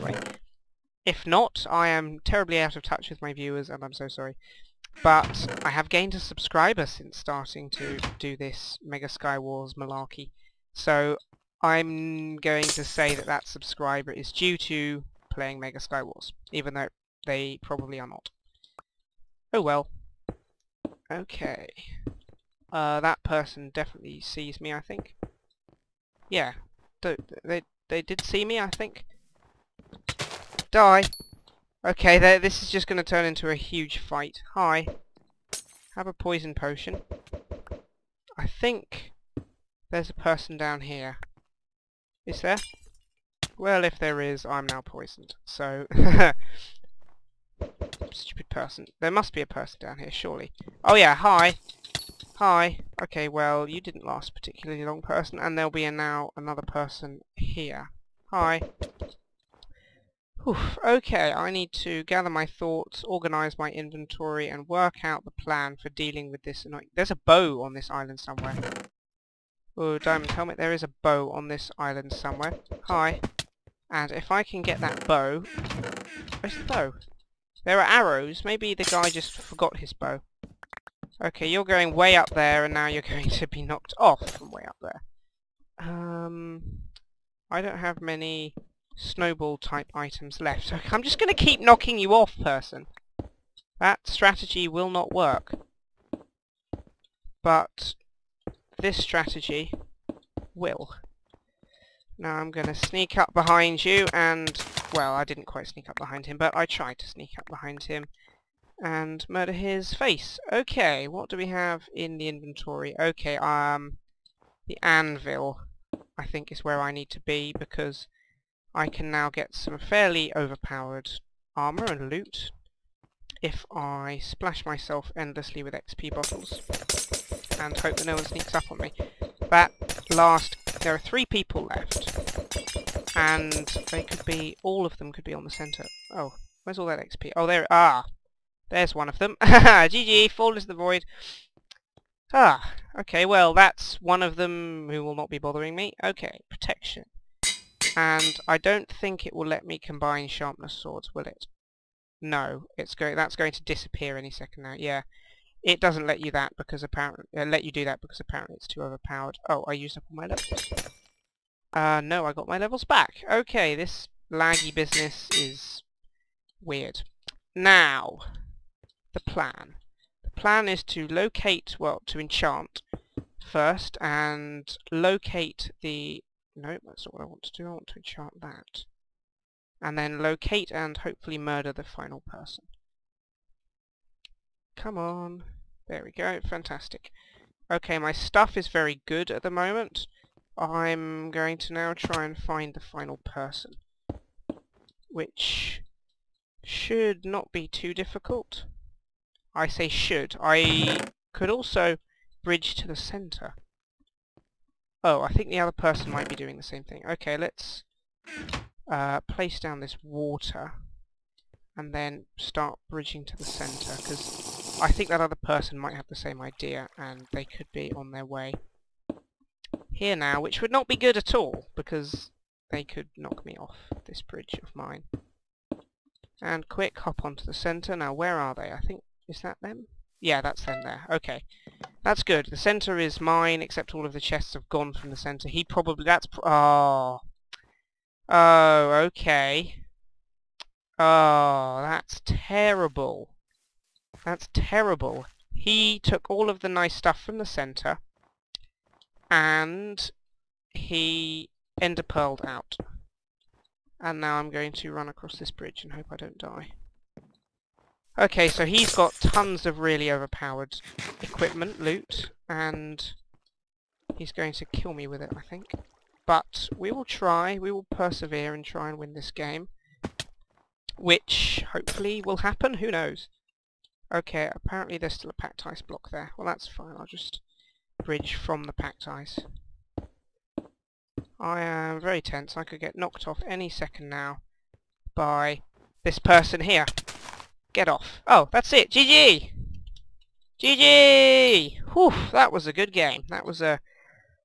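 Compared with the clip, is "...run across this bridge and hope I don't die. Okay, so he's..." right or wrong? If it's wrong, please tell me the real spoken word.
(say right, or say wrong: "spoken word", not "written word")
right.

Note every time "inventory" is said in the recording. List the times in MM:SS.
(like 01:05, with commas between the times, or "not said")
01:03, 01:52.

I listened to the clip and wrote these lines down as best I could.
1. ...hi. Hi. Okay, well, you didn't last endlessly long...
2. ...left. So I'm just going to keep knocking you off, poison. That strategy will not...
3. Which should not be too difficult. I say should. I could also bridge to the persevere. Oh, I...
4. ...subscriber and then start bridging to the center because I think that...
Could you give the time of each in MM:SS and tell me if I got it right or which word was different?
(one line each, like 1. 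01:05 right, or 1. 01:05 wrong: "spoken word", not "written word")
1. 00:51 wrong: "particularly", not "endlessly"
2. 01:30 wrong: "person", not "poison"
3. 03:15 wrong: "centre", not "persevere"
4. 03:30 wrong: "water", not "subscriber".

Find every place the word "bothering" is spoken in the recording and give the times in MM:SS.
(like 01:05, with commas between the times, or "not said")
02:25.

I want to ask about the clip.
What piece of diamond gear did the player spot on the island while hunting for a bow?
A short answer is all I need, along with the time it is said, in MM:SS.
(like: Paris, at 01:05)
Diamond helmet, at 01:09.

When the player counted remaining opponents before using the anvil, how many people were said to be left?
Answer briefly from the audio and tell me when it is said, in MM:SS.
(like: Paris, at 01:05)
3, at 02:10.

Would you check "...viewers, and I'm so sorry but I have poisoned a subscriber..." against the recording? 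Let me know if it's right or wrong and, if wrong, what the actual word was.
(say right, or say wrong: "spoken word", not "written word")
wrong: "gained", not "poisoned".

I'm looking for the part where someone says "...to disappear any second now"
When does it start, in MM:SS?
02:33.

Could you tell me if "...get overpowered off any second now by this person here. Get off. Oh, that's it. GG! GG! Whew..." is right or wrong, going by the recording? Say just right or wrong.
wrong.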